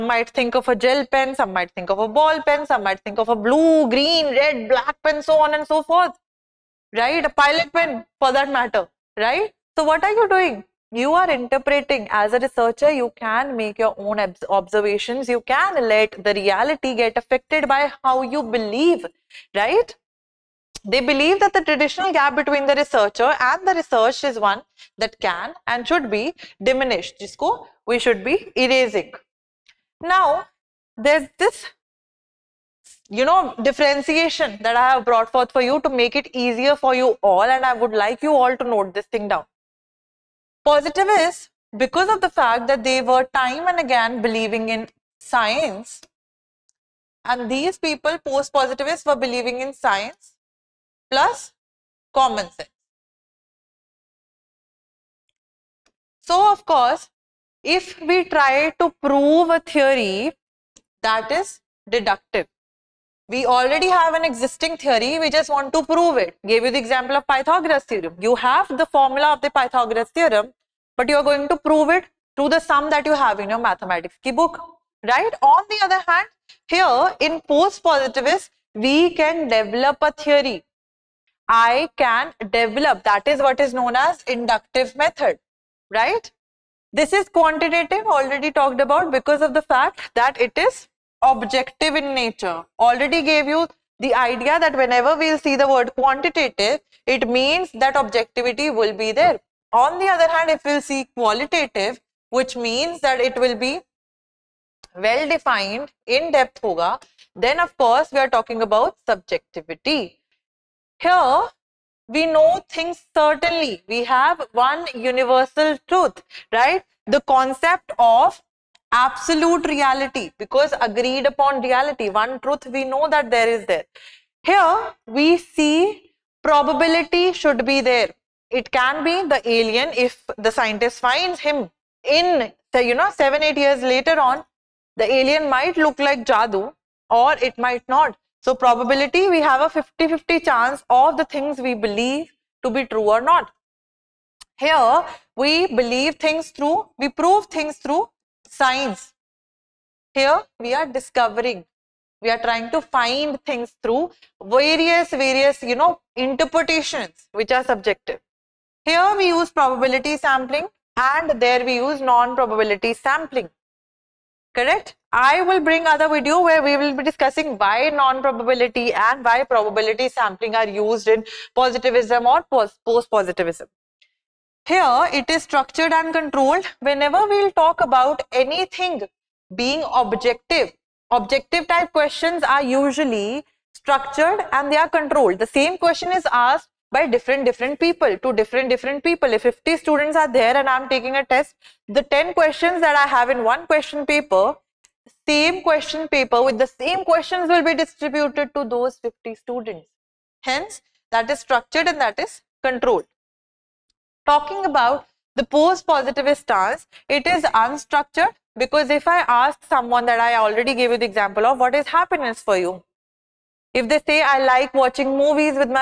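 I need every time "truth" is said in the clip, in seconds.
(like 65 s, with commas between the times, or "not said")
115 s, 122 s.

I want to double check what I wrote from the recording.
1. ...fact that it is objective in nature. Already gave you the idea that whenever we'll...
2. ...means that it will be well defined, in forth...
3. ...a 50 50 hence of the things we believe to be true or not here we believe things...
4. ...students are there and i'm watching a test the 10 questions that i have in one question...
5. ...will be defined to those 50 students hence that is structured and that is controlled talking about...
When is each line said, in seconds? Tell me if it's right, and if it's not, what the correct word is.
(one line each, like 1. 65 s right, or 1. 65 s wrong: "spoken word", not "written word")
1. 89 s right
2. 102 s wrong: "depth", not "forth"
3. 139 s wrong: "chance", not "hence"
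4. 189 s wrong: "taking", not "watching"
5. 197 s wrong: "distributed", not "defined".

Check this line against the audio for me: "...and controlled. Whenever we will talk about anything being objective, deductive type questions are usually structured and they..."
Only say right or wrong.
wrong.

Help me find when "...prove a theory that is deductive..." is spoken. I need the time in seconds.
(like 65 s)
59 s.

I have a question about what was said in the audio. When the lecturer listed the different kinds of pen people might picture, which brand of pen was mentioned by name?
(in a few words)
Pilot.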